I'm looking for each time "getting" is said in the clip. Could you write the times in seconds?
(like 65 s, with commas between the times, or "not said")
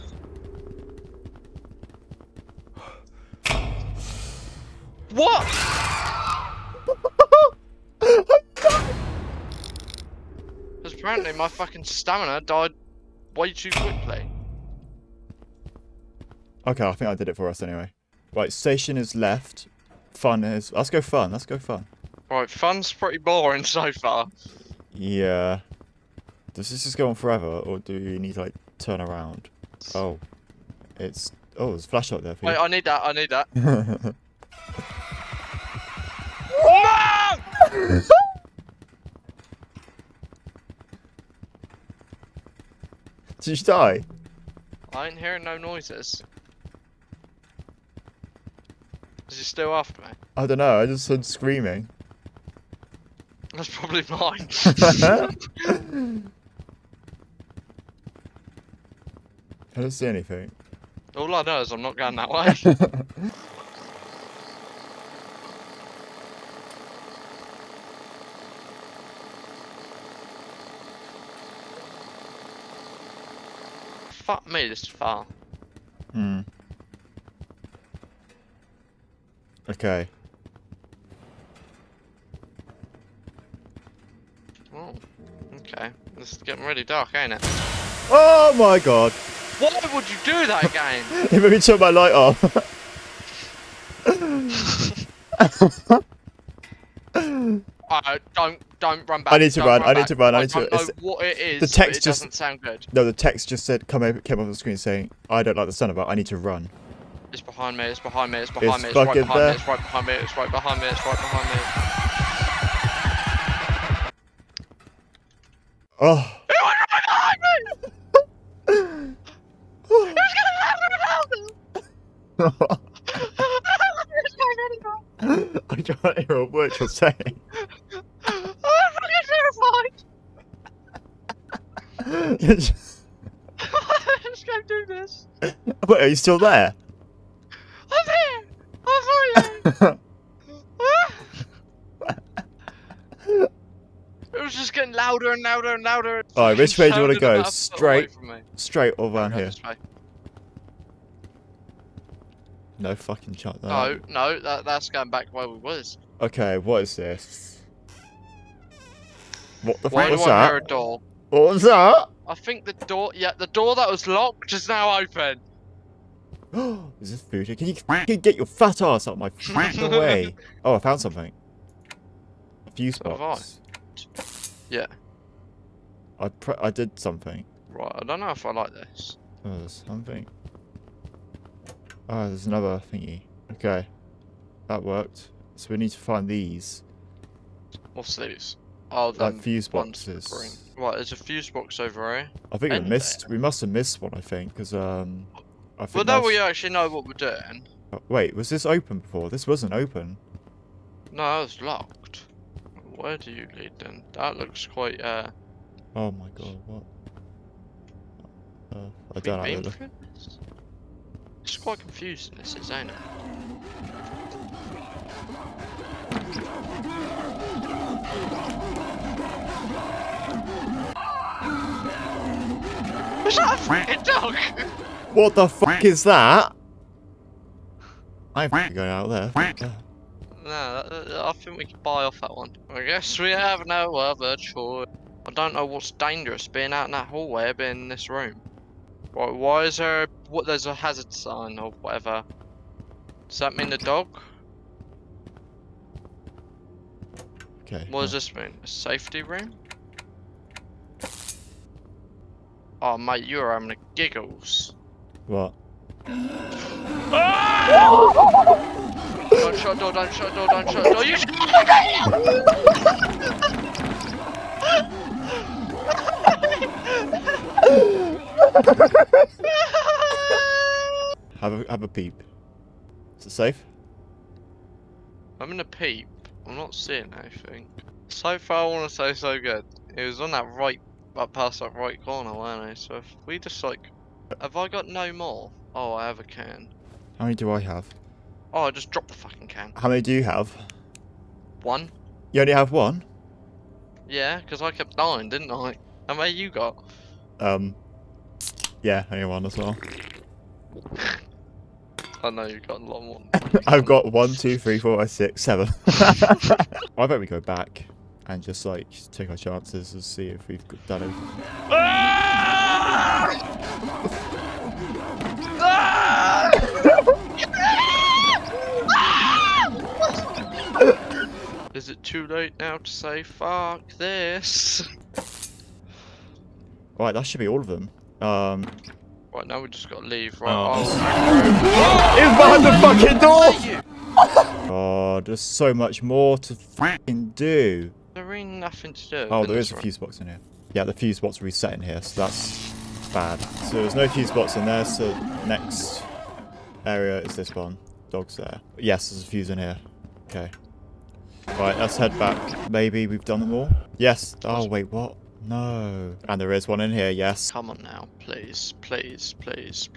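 86 s, 144 s.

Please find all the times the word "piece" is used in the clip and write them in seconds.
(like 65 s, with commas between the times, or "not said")
not said.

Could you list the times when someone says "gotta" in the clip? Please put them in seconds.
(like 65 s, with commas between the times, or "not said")
329 s.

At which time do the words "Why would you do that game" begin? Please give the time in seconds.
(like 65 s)
89 s.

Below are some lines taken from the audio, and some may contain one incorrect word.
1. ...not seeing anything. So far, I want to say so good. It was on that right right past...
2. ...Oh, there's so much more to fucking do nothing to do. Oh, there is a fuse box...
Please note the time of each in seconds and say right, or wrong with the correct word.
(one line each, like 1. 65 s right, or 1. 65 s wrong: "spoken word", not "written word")
1. 276 s right
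2. 334 s right.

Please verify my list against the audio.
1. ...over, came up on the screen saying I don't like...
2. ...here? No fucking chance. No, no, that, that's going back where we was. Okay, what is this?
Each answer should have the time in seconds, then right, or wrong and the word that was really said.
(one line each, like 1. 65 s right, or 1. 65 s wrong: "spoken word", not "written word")
1. 104 s right
2. 149 s right.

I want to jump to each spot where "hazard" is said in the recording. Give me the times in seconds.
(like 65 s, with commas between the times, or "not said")
240 s.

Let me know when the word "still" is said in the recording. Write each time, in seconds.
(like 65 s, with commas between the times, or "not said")
49 s, 136 s.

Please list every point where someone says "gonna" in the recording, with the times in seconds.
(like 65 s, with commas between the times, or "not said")
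120 s, 275 s.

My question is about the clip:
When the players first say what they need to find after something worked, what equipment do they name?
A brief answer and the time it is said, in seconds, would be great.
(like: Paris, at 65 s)
fuse boxes, at 189 s.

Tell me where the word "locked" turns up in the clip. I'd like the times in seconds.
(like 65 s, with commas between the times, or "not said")
164 s, 201 s.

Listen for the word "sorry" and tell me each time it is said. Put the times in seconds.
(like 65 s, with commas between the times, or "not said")
139 s.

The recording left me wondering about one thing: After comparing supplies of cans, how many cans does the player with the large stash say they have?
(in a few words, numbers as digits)
7.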